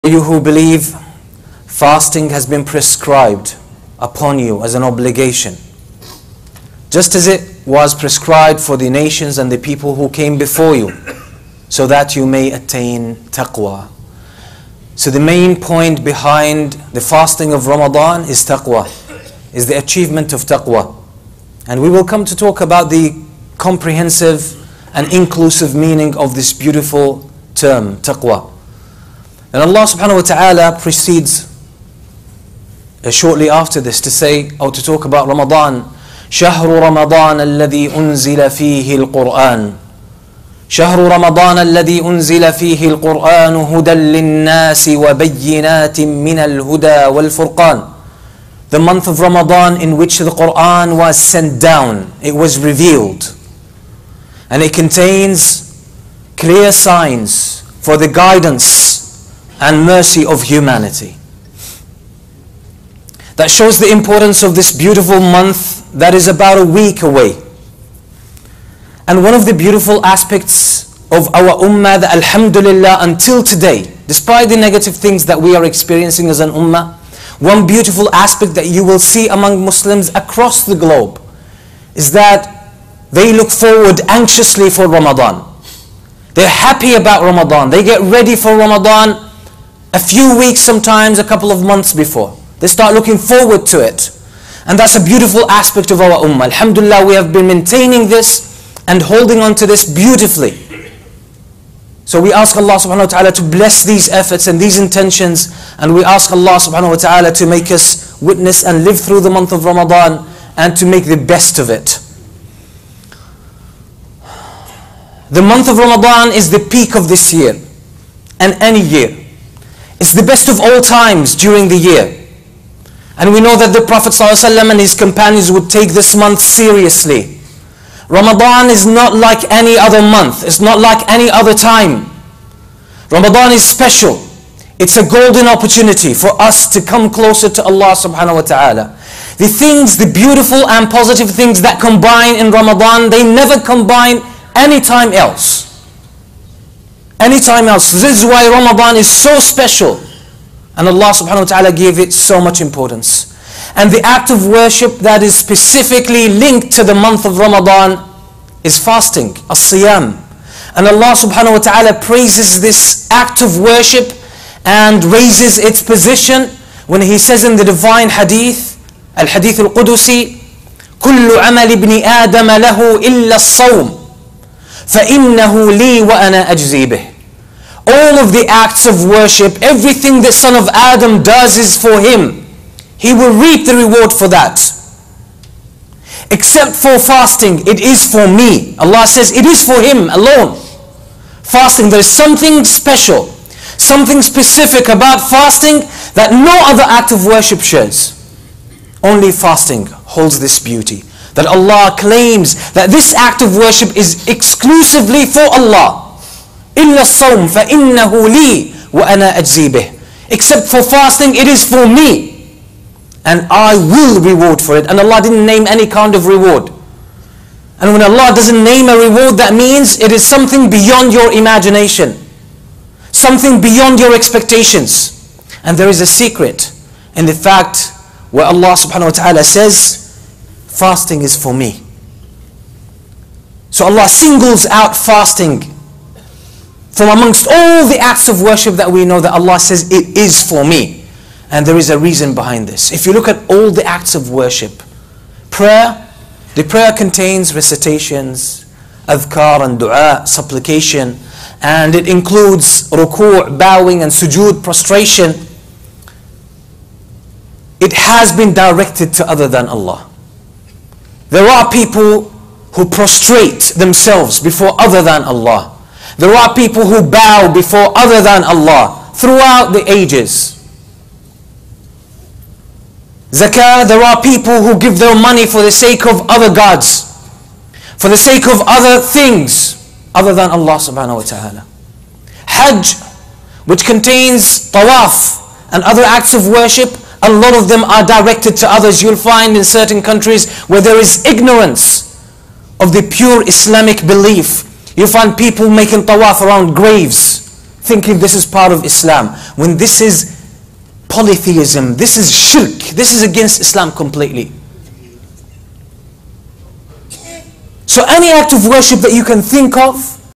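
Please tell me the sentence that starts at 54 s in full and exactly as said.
And it contains clear signs for the guidance and mercy of humanity.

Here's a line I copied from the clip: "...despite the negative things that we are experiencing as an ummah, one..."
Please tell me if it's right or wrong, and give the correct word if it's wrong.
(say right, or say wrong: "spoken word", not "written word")
right.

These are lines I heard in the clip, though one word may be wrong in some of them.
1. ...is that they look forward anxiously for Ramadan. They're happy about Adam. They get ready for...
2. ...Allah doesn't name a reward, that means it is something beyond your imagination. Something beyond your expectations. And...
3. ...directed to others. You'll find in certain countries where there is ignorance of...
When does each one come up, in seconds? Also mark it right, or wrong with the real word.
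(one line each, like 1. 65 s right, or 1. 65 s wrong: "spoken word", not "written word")
1. 81 s wrong: "Ramadan", not "Adam"
2. 218 s right
3. 288 s right.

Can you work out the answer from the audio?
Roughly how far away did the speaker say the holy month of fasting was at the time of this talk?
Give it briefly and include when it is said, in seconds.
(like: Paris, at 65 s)
About a week, at 66 s.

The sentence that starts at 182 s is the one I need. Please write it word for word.
He will reap the reward for that.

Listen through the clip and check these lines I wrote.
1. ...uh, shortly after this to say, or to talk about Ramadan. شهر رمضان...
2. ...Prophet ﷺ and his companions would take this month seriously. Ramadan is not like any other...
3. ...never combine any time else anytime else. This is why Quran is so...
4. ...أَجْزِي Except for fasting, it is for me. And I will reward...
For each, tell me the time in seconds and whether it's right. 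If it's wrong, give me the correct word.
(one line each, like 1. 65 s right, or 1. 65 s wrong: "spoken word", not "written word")
1. 33 s right
2. 123 s right
3. 143 s wrong: "Ramadan", not "Quran"
4. 209 s right.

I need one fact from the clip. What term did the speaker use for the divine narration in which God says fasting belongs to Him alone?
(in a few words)
Al-Hadith al-Qudusi.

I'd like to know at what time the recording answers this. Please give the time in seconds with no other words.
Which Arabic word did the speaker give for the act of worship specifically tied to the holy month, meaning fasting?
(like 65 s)
159 s.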